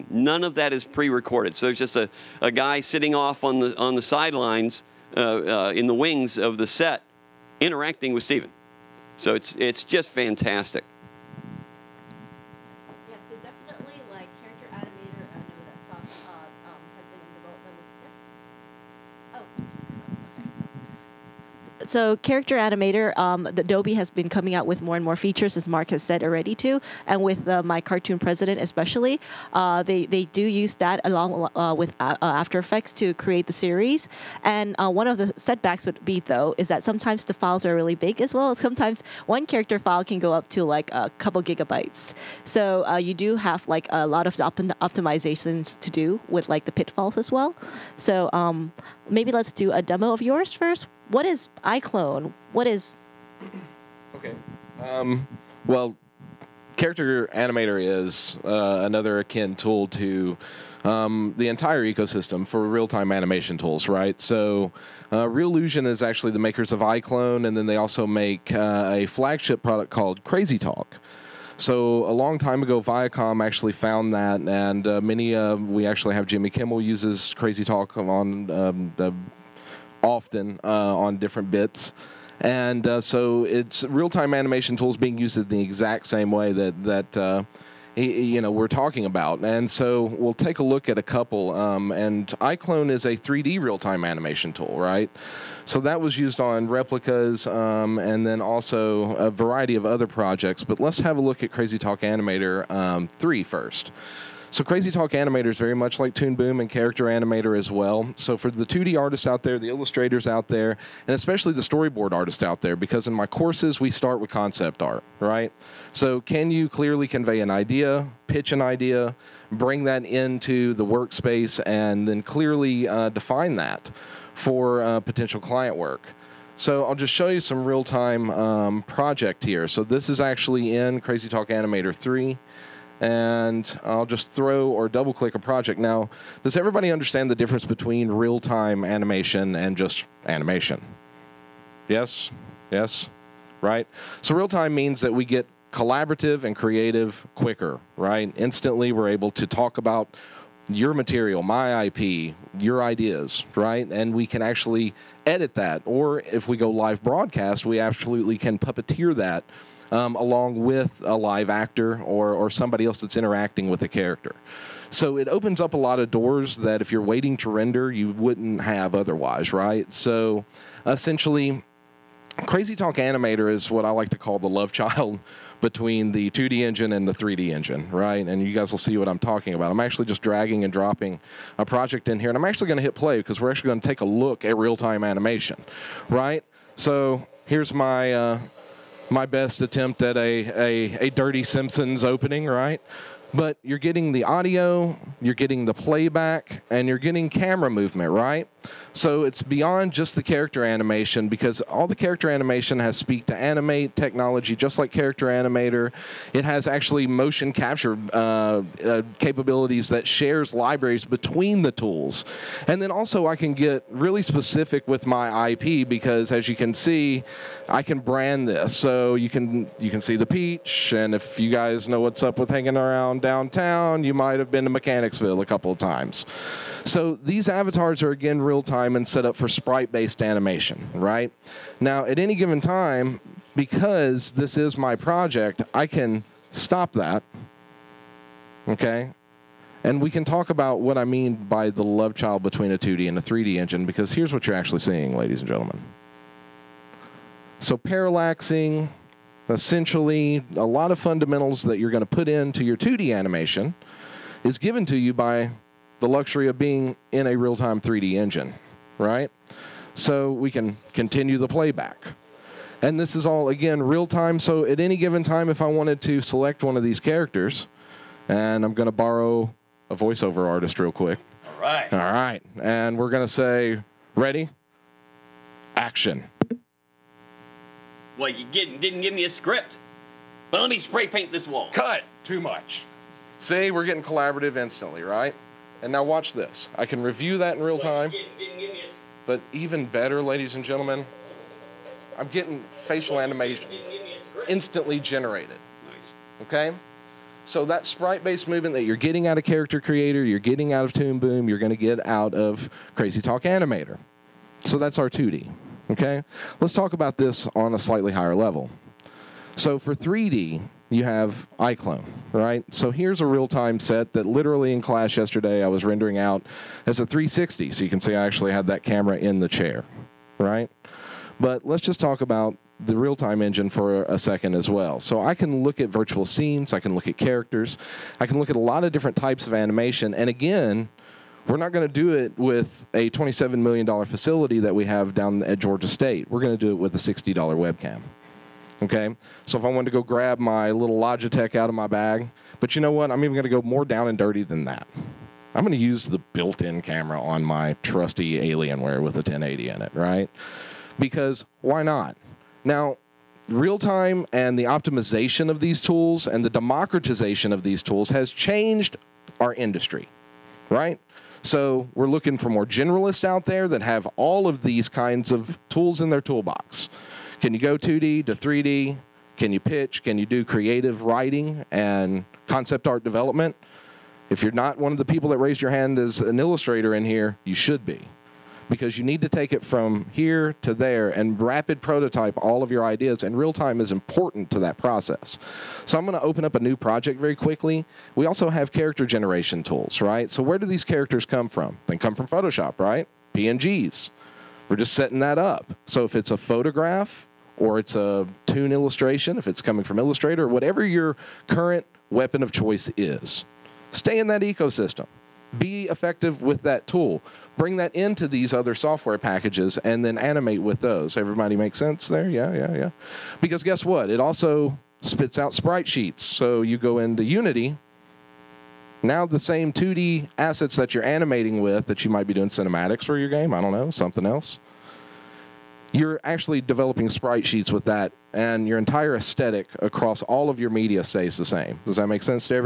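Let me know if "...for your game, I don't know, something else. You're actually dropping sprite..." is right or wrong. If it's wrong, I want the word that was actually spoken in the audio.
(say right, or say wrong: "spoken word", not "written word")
wrong: "developing", not "dropping".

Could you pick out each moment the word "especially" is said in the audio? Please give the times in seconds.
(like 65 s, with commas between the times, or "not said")
28 s, 111 s.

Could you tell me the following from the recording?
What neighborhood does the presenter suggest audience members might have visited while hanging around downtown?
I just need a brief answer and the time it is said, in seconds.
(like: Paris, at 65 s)
Mechanicsville, at 224 s.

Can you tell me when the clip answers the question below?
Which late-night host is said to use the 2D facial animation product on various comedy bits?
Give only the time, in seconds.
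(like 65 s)
76 s.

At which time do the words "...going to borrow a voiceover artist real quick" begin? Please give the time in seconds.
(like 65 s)
268 s.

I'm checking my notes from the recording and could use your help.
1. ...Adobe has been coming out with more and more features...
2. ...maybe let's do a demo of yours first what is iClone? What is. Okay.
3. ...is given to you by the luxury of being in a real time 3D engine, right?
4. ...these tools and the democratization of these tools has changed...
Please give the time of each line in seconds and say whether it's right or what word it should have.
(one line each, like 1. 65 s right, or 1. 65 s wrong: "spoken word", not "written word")
1. 23 s right
2. 49 s right
3. 254 s right
4. 355 s right.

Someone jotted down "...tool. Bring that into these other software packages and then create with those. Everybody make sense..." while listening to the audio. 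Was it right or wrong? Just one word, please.
wrong.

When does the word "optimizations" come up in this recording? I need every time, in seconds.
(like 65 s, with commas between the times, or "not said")
44 s, 354 s.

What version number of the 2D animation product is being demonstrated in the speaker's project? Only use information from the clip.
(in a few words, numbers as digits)
3.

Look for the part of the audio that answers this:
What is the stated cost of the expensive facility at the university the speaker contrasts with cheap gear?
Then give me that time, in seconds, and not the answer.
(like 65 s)
333 s.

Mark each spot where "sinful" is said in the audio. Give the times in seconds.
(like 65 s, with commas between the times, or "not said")
not said.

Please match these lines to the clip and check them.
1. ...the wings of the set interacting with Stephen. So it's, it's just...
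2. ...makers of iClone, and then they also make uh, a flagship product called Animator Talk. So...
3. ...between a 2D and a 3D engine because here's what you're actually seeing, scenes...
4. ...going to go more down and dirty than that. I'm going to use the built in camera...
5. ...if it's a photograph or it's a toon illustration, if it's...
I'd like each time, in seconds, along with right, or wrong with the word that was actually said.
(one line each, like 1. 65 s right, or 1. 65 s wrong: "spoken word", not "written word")
1. 5 s right
2. 66 s wrong: "Crazy", not "Animator"
3. 242 s wrong: "ladies", not "scenes"
4. 343 s right
5. 396 s right.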